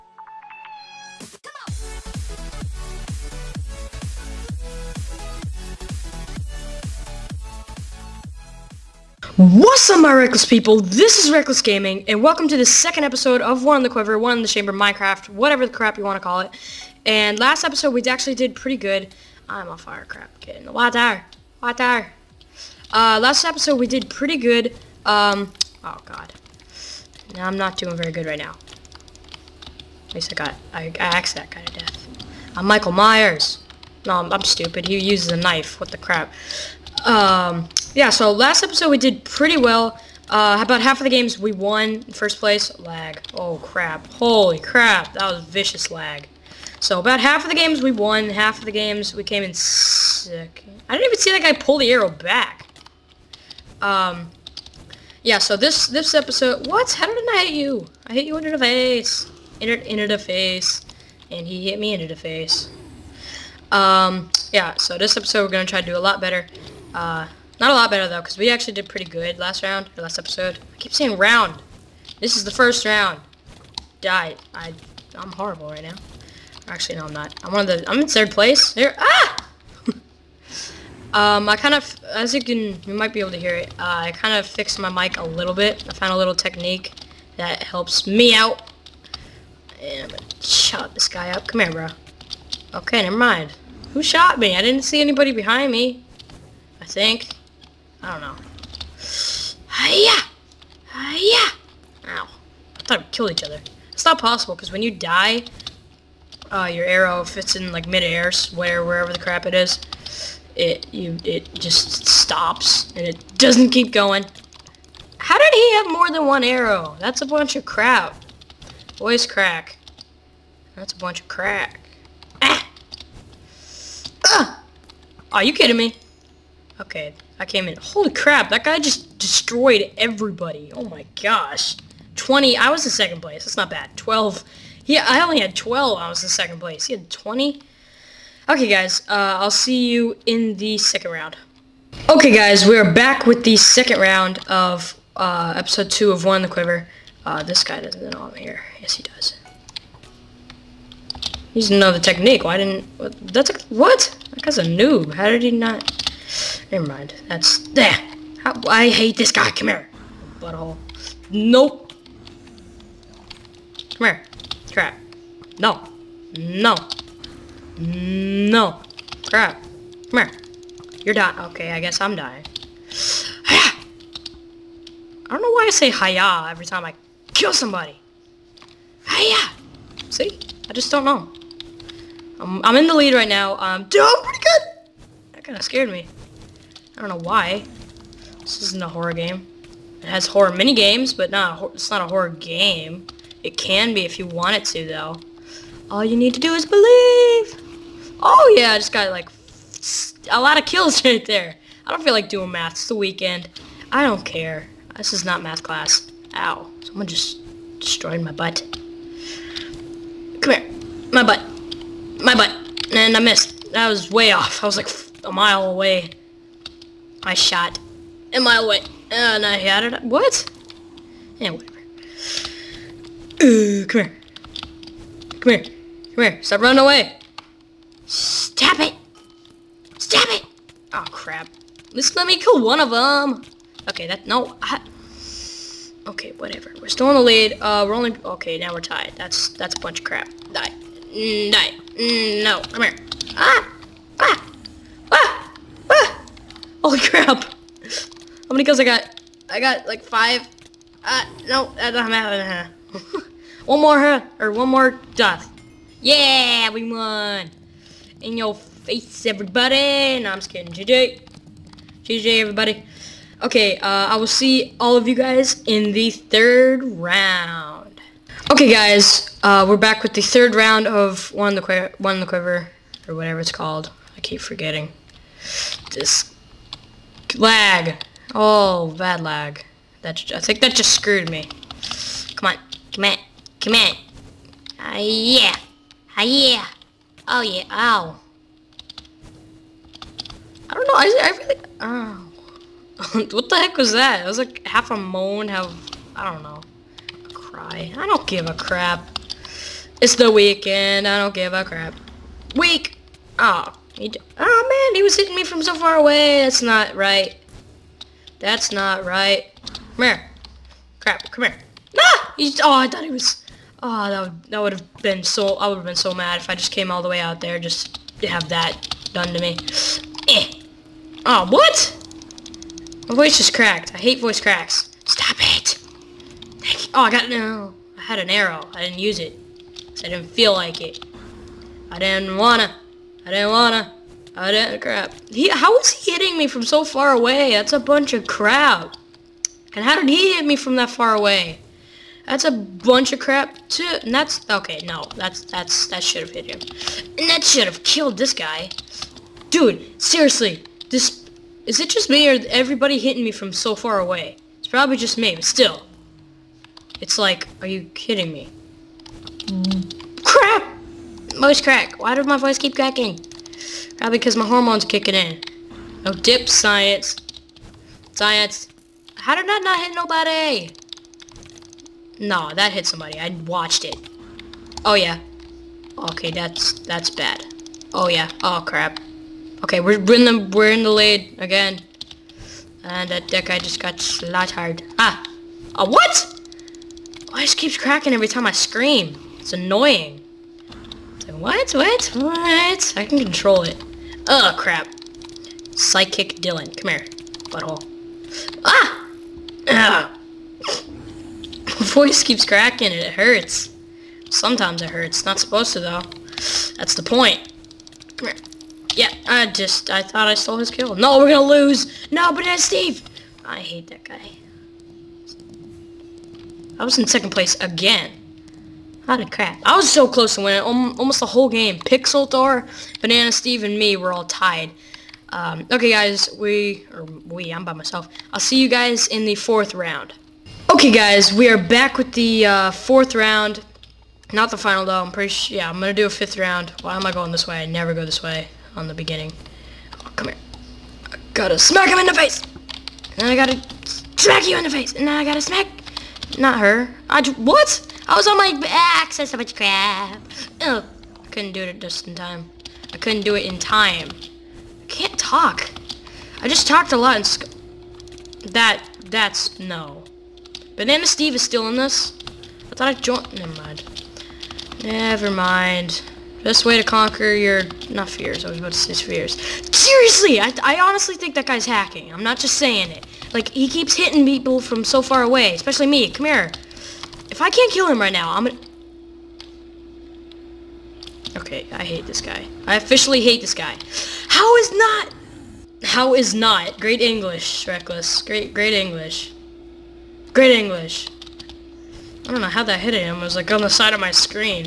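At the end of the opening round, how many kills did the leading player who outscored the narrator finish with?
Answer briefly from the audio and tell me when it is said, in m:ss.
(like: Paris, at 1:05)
20, at 2:16.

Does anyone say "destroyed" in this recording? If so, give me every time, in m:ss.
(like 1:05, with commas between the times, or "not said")
2:09, 3:27.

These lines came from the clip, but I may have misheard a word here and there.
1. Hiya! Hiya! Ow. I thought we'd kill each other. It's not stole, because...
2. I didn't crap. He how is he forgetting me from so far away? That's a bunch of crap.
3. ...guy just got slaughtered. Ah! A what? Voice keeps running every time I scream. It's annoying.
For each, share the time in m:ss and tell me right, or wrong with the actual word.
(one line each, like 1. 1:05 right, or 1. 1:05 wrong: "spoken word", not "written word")
1. 1:39 wrong: "possible", not "stole"
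2. 5:34 wrong: "hitting", not "forgetting"
3. 6:23 wrong: "cracking", not "running".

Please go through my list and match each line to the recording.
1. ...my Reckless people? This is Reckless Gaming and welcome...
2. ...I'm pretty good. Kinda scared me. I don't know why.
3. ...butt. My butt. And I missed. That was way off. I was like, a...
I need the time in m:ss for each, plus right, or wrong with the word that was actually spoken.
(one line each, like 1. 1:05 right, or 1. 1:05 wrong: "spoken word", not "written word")
1. 0:09 right
2. 3:03 right
3. 3:31 right.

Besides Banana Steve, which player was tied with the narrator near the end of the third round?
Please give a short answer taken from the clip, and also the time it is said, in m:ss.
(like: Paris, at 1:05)
Pixel Thor, at 7:01.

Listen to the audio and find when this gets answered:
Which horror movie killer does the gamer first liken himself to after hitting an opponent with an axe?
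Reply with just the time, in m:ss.
0:32.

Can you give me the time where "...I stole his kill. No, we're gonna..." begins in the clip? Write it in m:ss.
6:50.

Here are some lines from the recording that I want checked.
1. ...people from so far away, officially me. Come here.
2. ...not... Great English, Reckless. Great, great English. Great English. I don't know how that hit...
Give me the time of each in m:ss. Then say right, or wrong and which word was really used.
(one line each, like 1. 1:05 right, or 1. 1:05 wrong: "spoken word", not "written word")
1. 7:54 wrong: "especially", not "officially"
2. 8:06 right.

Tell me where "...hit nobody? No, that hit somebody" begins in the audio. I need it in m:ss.
6:09.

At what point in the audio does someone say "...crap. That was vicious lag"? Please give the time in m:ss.
0:44.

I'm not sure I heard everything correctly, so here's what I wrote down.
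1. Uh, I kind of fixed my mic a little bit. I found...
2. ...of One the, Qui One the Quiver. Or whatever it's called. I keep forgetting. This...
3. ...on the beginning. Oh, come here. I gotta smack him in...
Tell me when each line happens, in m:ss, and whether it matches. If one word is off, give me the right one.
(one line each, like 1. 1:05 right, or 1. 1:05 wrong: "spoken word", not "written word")
1. 1:23 right
2. 4:30 right
3. 7:18 right.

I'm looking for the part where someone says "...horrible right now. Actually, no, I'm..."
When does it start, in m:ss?
1:15.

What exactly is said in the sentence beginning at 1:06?
Uh, not a lot better though, because we actually did pretty good last round, or last episode.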